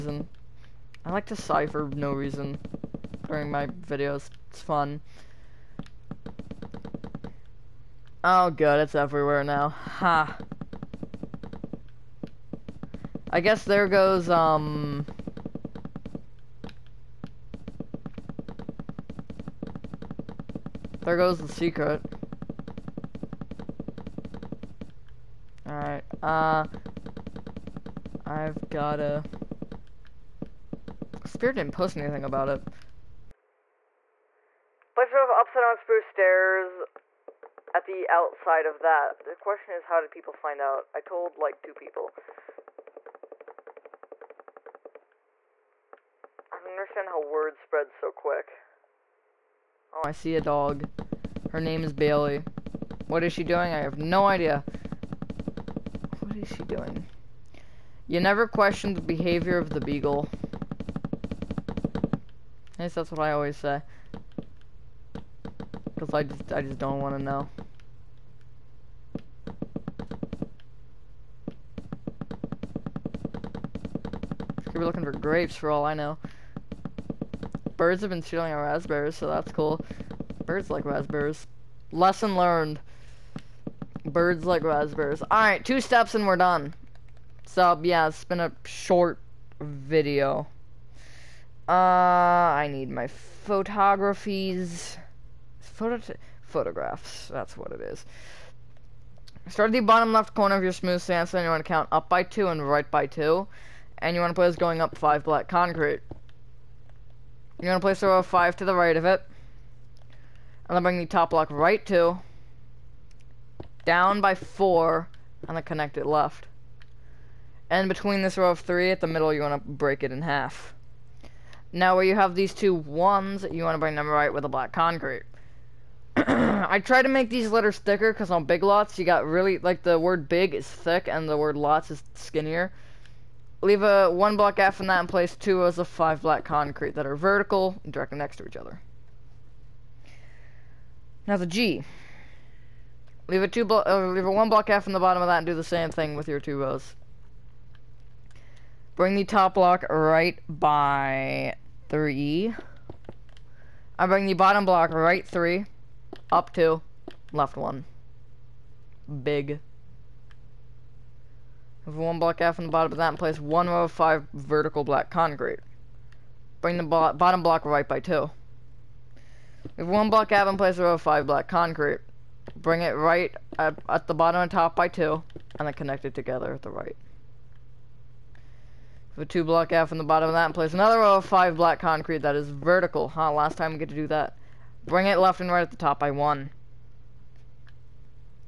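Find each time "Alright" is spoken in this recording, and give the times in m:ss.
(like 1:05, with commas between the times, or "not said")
0:25, 1:25.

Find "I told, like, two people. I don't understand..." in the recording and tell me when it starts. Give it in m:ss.
0:40.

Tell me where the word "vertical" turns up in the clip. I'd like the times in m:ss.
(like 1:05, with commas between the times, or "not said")
2:17, 2:44, 3:02.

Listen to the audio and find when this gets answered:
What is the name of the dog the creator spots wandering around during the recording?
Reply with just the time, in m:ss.
0:51.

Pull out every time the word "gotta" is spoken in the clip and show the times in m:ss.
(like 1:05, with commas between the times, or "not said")
0:28.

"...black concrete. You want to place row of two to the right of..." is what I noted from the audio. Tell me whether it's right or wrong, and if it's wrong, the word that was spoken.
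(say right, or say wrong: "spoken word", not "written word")
wrong: "five", not "two".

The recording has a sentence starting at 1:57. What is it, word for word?
And between this row of three at the middle, you want to break it in half.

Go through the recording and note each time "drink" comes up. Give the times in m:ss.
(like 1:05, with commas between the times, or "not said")
not said.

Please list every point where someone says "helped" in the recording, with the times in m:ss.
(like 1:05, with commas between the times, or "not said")
not said.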